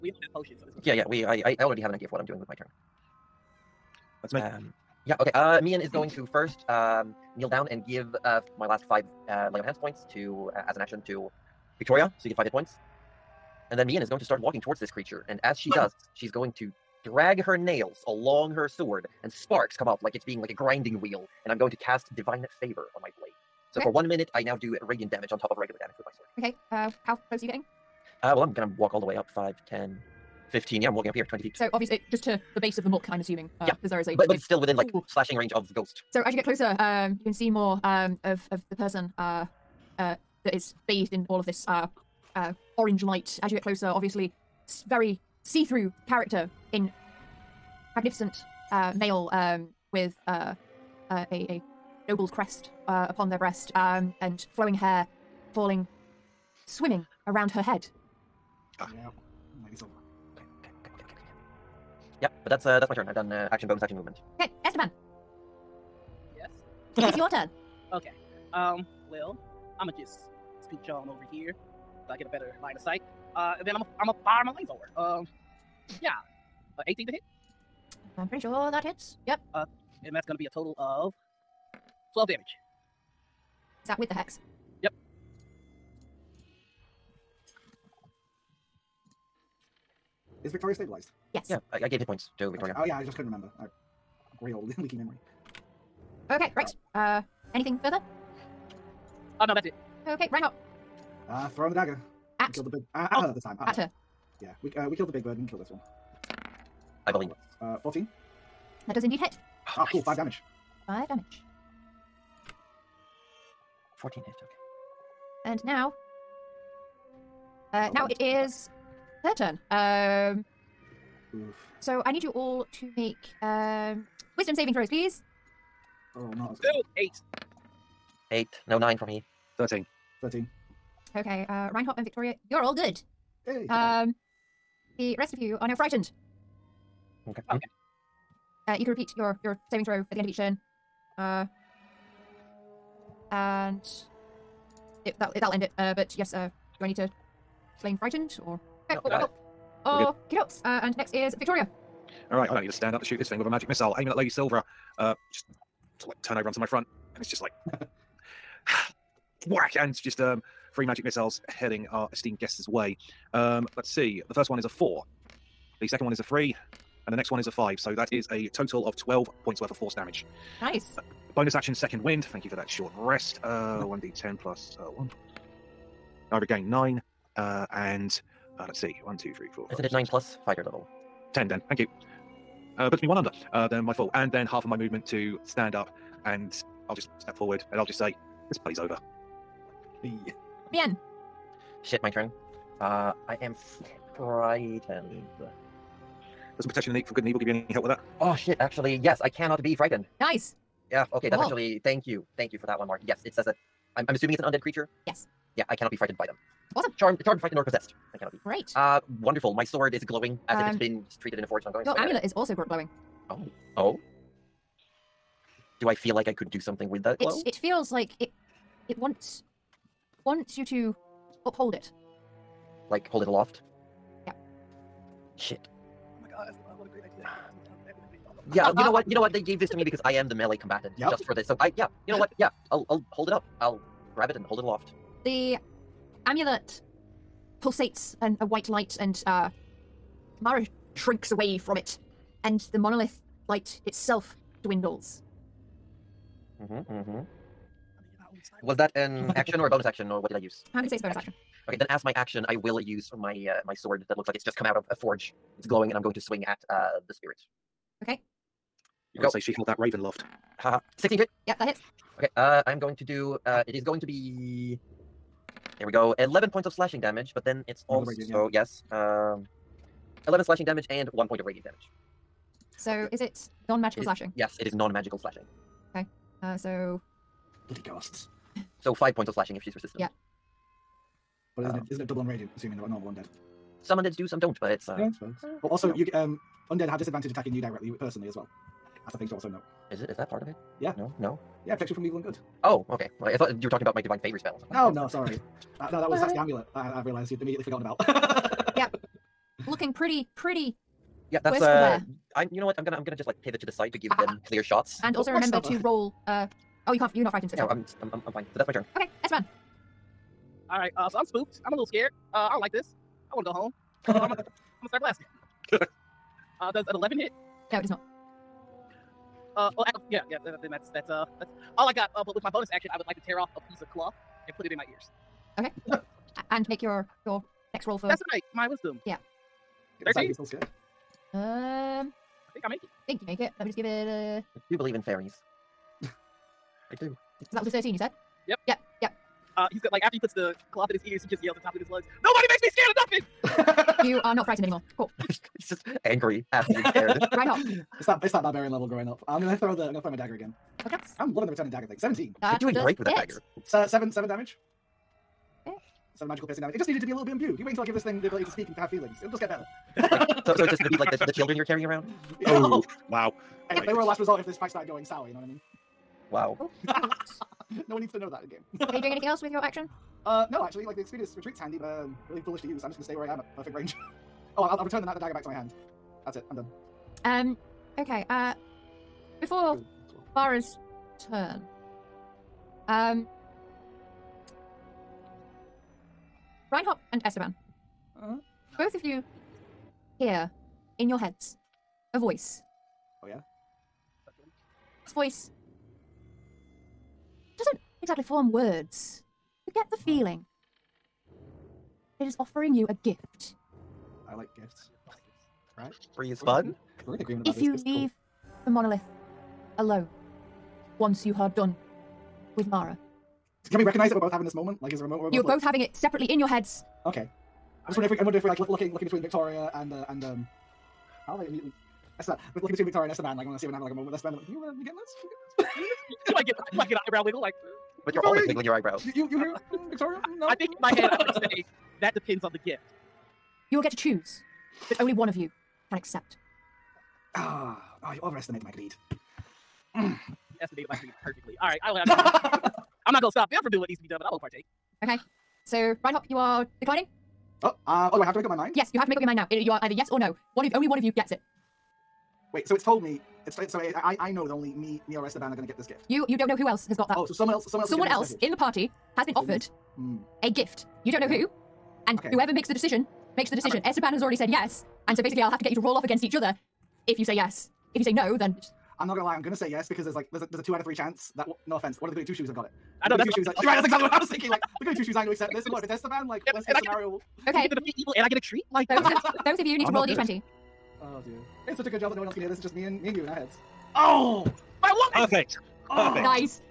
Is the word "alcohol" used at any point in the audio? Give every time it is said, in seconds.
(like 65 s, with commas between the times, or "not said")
not said.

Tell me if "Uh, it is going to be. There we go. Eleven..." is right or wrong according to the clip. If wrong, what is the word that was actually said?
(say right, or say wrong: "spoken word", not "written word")
right.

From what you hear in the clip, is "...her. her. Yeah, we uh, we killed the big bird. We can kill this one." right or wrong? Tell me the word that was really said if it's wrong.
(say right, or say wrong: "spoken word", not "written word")
right.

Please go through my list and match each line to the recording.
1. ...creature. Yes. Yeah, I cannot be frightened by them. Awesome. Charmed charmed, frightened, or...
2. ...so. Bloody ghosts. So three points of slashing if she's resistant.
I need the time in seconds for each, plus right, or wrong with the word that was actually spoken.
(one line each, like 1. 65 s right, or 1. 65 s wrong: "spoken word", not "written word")
1. 204 s right
2. 276 s wrong: "five", not "three".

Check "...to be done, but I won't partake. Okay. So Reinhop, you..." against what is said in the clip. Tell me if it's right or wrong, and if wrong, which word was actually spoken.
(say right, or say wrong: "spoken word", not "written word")
right.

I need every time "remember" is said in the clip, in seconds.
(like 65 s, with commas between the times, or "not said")
93 s, 305 s.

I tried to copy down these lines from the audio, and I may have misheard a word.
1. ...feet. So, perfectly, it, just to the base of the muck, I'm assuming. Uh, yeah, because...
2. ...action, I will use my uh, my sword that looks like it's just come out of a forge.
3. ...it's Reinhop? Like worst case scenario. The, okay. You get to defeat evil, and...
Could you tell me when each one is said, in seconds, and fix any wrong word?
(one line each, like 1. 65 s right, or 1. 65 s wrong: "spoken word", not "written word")
1. 31 s wrong: "obviously", not "perfectly"
2. 252 s right
3. 475 s wrong: "Esteban", not "Reinhop".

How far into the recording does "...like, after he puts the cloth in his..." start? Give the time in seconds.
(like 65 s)
339 s.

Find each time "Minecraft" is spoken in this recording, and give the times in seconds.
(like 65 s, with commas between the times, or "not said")
not said.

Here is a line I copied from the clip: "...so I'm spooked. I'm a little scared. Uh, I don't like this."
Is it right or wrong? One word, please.
right.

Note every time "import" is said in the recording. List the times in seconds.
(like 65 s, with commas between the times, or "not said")
not said.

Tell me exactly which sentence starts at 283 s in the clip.
Some undeads do, some don't, but it's.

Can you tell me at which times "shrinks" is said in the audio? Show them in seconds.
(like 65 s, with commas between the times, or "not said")
240 s.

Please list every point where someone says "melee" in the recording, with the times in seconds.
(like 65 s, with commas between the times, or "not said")
230 s.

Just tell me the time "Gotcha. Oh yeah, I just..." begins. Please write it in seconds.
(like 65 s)
92 s.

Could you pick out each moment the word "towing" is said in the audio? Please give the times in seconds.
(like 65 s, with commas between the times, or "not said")
not said.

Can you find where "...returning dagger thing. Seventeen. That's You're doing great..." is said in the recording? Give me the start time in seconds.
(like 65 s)
351 s.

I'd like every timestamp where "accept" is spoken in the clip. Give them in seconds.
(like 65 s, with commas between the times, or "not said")
435 s, 475 s.